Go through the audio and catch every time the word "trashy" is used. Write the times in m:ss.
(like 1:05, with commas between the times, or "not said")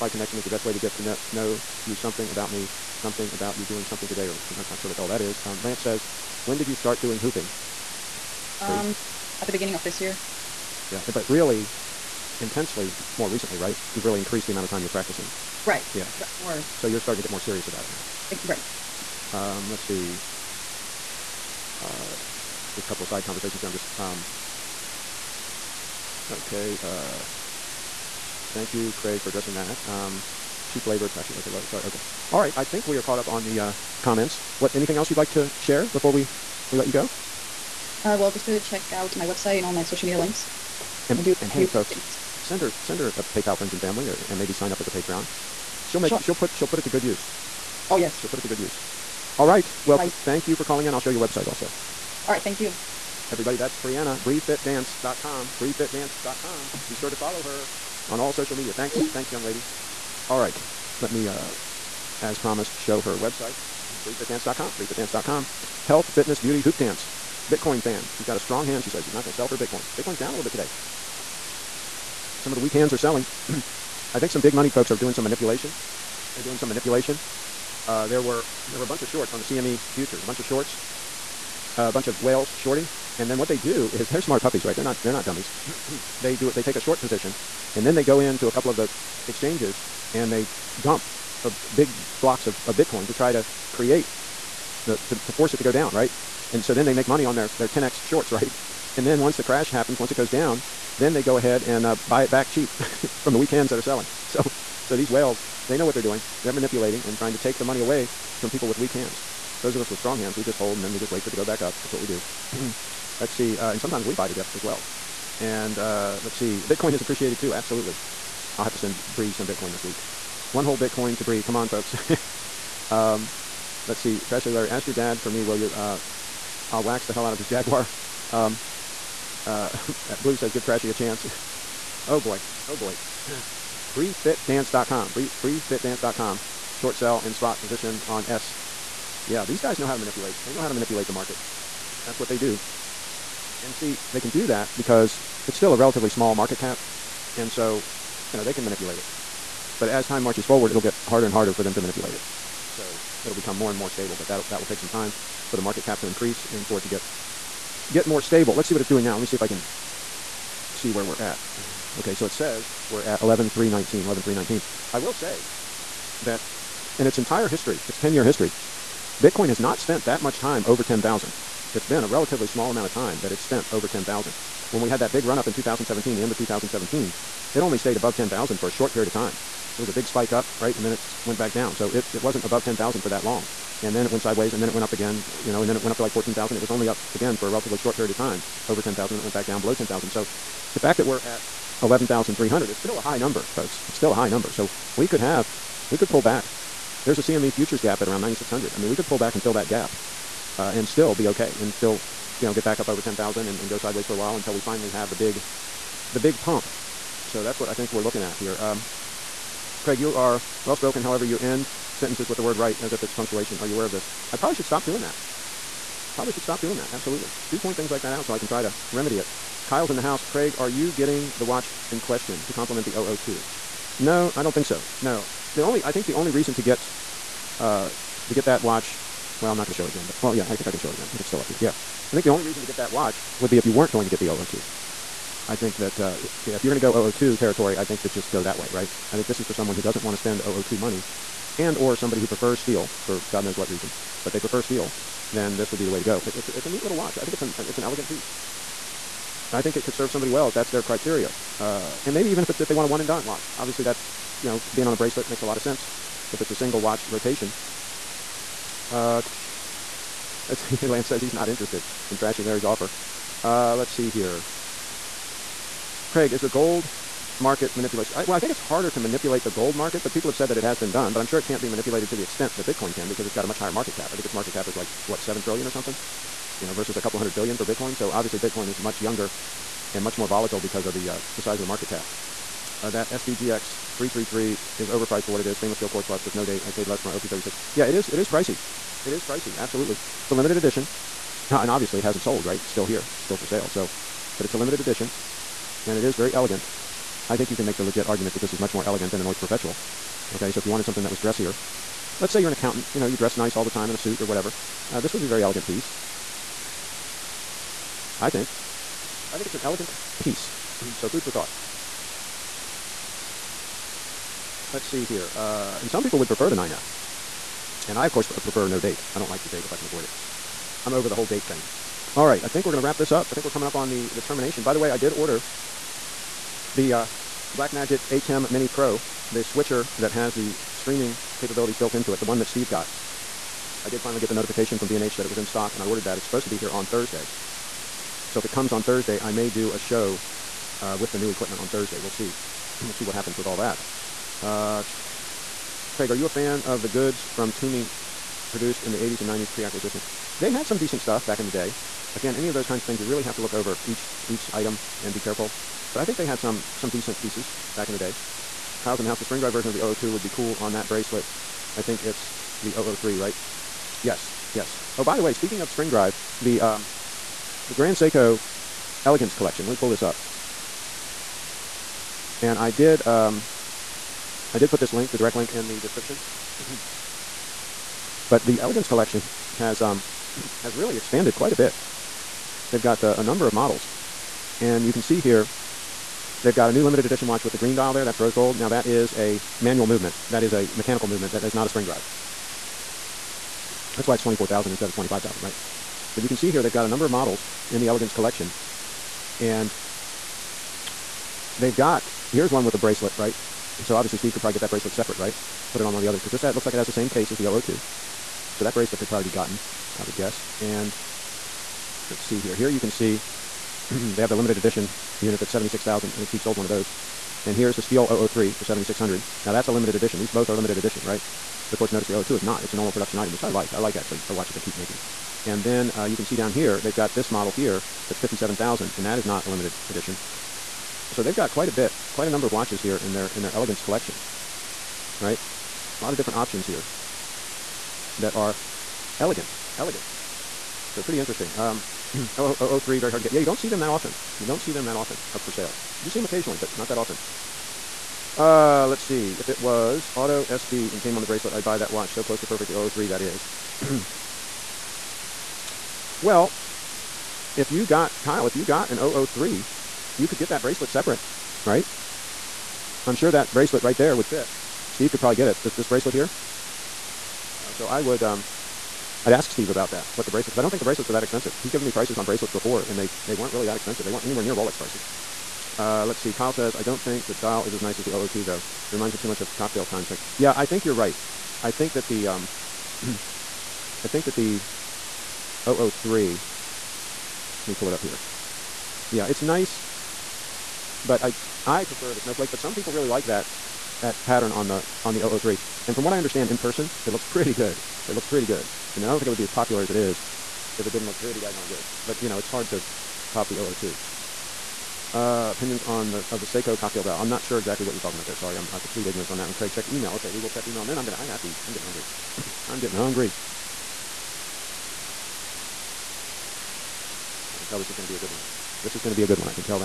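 0:31, 2:04, 2:10, 4:22.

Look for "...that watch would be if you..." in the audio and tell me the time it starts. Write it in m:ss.
3:52.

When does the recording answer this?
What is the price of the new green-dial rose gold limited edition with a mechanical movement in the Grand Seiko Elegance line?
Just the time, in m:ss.
6:34.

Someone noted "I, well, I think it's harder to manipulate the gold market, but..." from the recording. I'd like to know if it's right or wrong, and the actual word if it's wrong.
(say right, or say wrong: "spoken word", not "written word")
right.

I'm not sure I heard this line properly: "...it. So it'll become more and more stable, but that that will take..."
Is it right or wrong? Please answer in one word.
right.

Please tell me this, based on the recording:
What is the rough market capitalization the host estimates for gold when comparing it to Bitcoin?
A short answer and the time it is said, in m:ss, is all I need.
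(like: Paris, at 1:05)
7 trillion, at 4:35.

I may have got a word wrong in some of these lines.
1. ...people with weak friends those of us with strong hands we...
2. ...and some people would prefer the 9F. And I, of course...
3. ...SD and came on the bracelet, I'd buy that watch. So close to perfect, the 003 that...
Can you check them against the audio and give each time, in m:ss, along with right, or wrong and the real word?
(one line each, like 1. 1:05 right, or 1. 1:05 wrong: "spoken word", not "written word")
1. 1:48 wrong: "hands", not "friends"
2. 5:15 right
3. 7:30 right.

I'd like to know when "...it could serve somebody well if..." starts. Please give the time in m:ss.
4:09.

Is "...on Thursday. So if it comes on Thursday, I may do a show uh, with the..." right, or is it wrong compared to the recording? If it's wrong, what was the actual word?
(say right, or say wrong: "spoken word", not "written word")
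right.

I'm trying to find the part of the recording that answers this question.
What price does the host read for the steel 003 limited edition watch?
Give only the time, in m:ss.
6:58.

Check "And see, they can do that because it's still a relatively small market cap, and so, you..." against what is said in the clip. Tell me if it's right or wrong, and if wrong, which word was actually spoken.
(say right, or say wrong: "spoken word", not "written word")
right.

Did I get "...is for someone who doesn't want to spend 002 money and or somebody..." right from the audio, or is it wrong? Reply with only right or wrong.
right.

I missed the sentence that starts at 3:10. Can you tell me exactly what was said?
So the fact that we're at 11,300 is still a high number, folks.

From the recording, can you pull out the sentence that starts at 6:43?
So obviously Steve could probably get that bracelet separate, right?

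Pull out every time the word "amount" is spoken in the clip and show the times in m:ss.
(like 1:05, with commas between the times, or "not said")
0:14, 2:52.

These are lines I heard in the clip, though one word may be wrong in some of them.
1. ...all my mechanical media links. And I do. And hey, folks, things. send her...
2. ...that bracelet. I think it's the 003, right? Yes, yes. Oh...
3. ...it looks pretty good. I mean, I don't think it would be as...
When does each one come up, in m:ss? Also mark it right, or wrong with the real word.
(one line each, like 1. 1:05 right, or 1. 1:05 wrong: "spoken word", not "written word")
1. 0:39 wrong: "social", not "mechanical"
2. 6:00 right
3. 8:18 right.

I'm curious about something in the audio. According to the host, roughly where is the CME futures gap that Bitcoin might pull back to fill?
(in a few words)
9,600.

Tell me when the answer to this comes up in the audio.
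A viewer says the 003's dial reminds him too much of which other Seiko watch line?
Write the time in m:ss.
7:59.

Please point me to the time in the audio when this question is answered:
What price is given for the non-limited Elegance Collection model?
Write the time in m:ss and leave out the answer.
7:08.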